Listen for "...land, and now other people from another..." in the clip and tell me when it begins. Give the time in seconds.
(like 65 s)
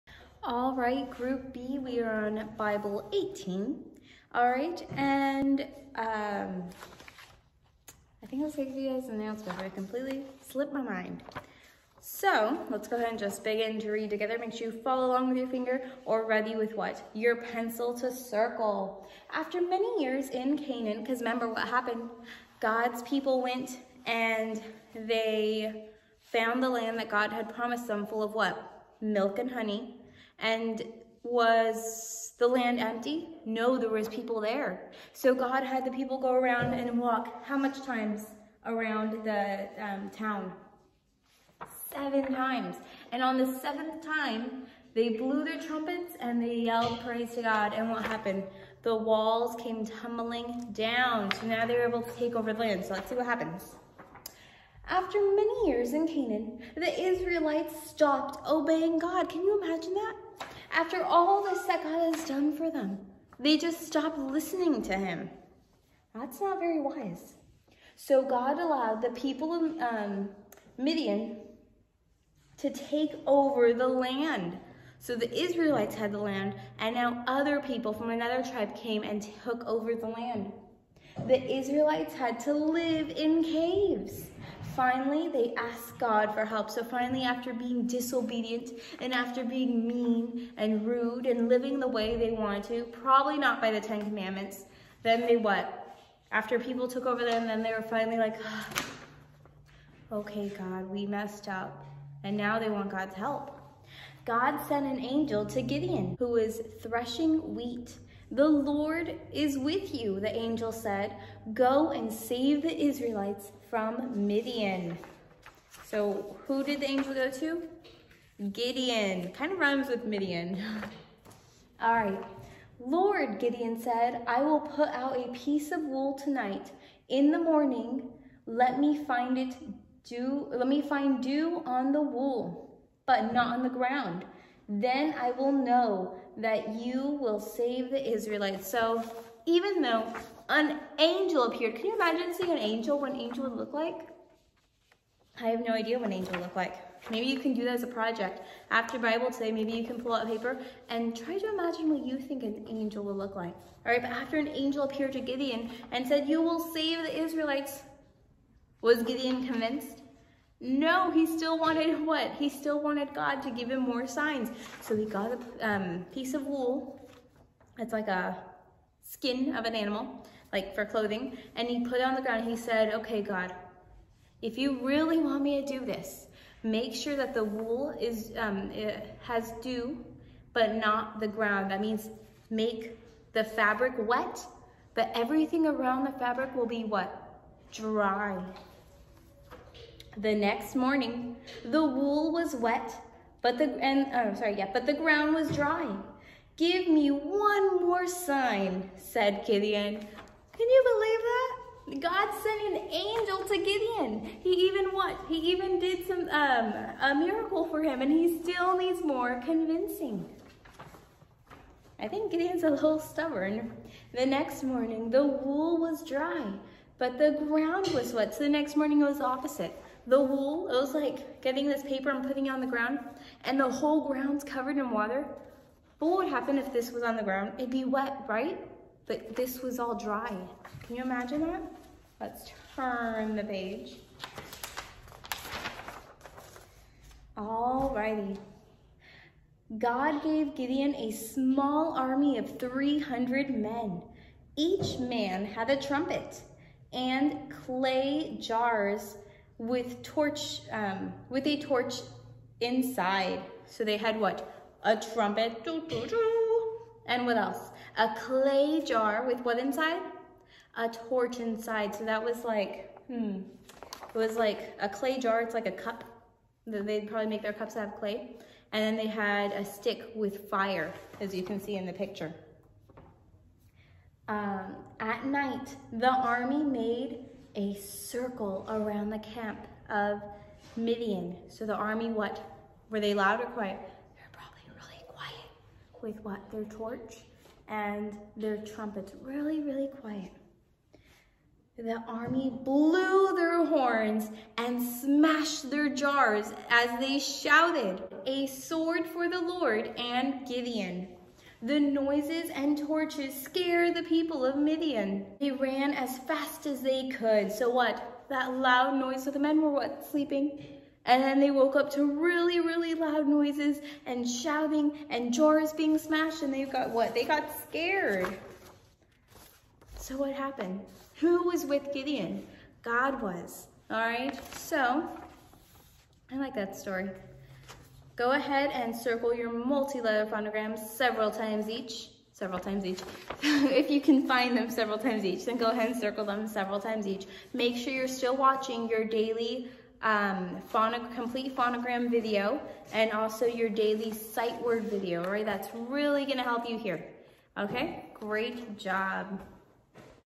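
76 s.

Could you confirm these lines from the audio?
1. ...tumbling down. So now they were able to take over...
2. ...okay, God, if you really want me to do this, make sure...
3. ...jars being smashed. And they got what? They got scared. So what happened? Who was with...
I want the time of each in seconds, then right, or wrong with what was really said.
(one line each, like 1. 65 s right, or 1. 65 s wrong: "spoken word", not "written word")
1. 49 s right
2. 172 s right
3. 315 s right.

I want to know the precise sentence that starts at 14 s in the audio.
Make sure you follow along with your finger or ready with what?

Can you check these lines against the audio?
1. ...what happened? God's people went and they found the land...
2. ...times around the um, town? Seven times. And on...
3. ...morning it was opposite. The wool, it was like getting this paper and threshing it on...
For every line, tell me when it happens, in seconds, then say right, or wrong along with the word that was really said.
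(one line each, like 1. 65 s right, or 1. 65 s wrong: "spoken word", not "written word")
1. 21 s right
2. 37 s right
3. 218 s wrong: "putting", not "threshing".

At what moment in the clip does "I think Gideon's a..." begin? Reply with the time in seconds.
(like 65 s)
212 s.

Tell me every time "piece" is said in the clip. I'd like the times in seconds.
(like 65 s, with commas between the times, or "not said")
125 s, 166 s.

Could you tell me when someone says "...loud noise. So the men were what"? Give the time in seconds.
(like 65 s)
308 s.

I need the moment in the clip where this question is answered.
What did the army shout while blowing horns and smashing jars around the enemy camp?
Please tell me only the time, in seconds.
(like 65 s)
298 s.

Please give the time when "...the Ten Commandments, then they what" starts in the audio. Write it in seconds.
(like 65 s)
93 s.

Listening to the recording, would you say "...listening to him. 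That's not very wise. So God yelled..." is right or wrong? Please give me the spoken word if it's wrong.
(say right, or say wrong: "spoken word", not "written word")
wrong: "allowed", not "yelled".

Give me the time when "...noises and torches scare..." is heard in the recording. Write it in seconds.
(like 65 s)
301 s.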